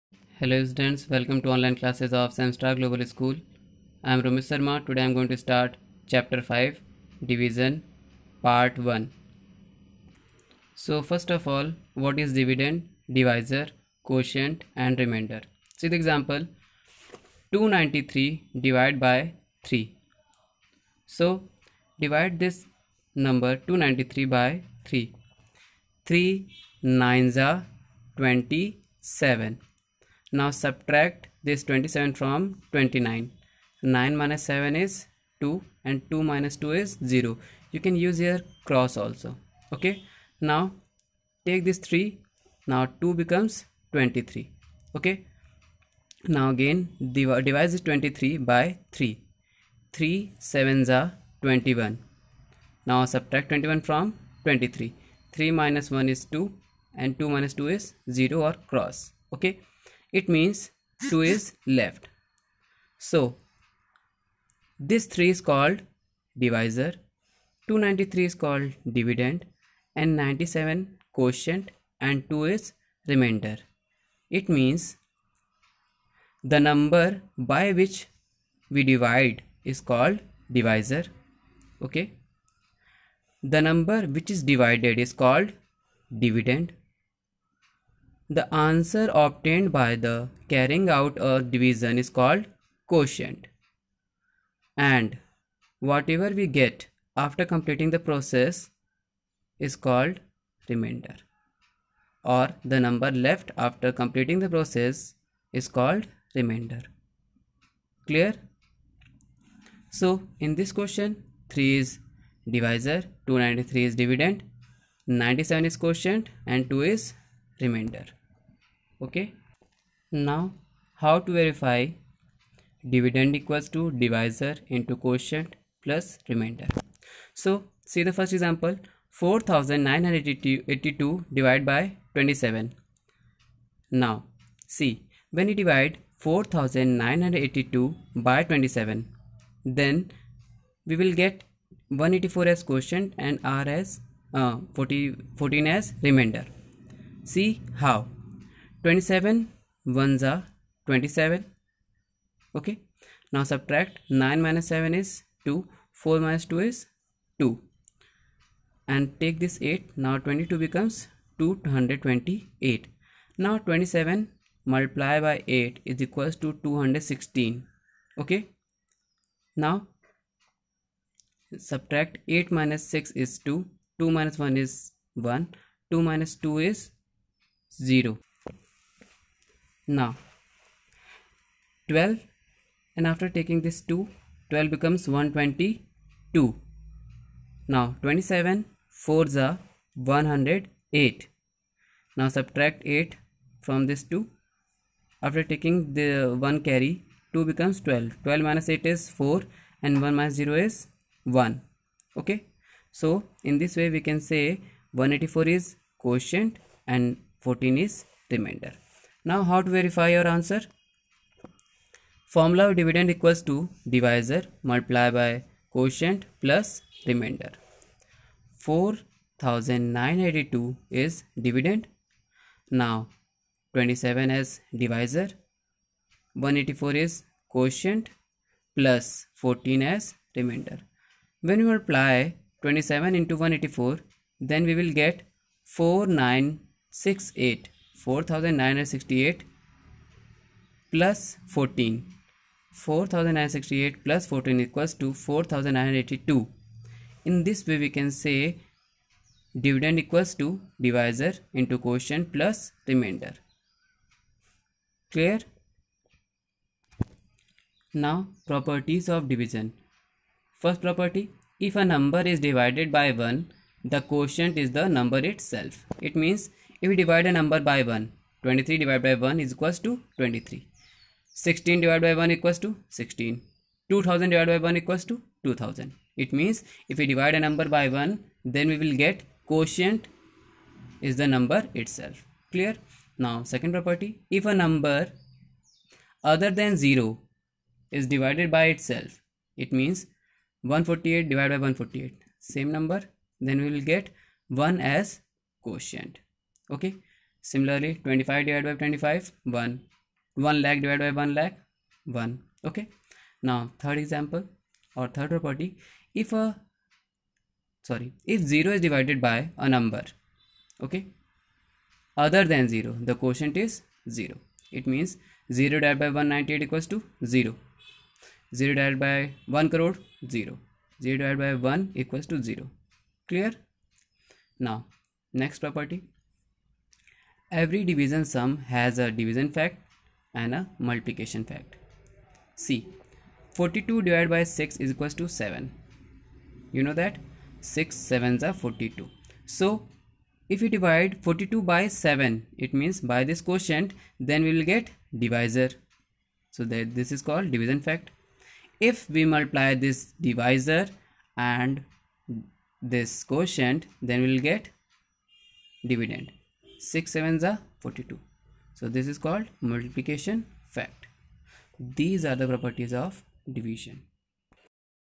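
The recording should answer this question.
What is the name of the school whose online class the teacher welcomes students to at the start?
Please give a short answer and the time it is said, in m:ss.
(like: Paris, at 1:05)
Semstar Global School, at 0:02.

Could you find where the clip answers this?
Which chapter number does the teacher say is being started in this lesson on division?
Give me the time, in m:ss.
0:06.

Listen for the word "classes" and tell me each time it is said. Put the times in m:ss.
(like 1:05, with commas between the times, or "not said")
0:01.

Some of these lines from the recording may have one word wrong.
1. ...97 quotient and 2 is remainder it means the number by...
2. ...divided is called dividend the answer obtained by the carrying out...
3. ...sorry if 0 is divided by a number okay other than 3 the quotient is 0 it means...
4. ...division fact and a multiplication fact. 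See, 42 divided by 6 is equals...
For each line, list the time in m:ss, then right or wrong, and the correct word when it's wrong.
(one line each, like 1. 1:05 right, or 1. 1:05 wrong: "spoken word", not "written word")
1. 1:10 right
2. 1:24 right
3. 5:07 wrong: "0", not "3"
4. 5:29 right.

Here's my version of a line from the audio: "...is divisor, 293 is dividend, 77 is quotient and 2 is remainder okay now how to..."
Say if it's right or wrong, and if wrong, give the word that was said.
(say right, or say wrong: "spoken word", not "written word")
wrong: "97", not "77".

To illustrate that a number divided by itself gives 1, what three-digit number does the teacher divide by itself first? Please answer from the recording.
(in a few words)
148.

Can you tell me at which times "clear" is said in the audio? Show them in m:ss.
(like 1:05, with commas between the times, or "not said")
1:48, 4:15, 4:42, 5:23.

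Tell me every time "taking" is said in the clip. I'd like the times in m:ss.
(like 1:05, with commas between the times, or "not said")
3:03, 3:15.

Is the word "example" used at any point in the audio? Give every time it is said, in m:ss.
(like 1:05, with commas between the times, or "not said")
0:16, 2:08, 5:04.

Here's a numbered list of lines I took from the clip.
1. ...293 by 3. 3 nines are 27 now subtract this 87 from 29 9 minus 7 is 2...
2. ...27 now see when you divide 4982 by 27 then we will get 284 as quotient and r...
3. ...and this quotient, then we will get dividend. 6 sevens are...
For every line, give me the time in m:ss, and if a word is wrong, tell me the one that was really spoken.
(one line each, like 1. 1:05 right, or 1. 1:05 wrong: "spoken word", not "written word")
1. 0:23 wrong: "27", not "87"
2. 2:12 wrong: "184", not "284"
3. 5:51 right.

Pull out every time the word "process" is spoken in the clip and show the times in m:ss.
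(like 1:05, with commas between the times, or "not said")
1:37, 1:44.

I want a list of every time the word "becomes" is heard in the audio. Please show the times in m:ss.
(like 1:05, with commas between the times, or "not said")
0:43, 3:04, 3:17.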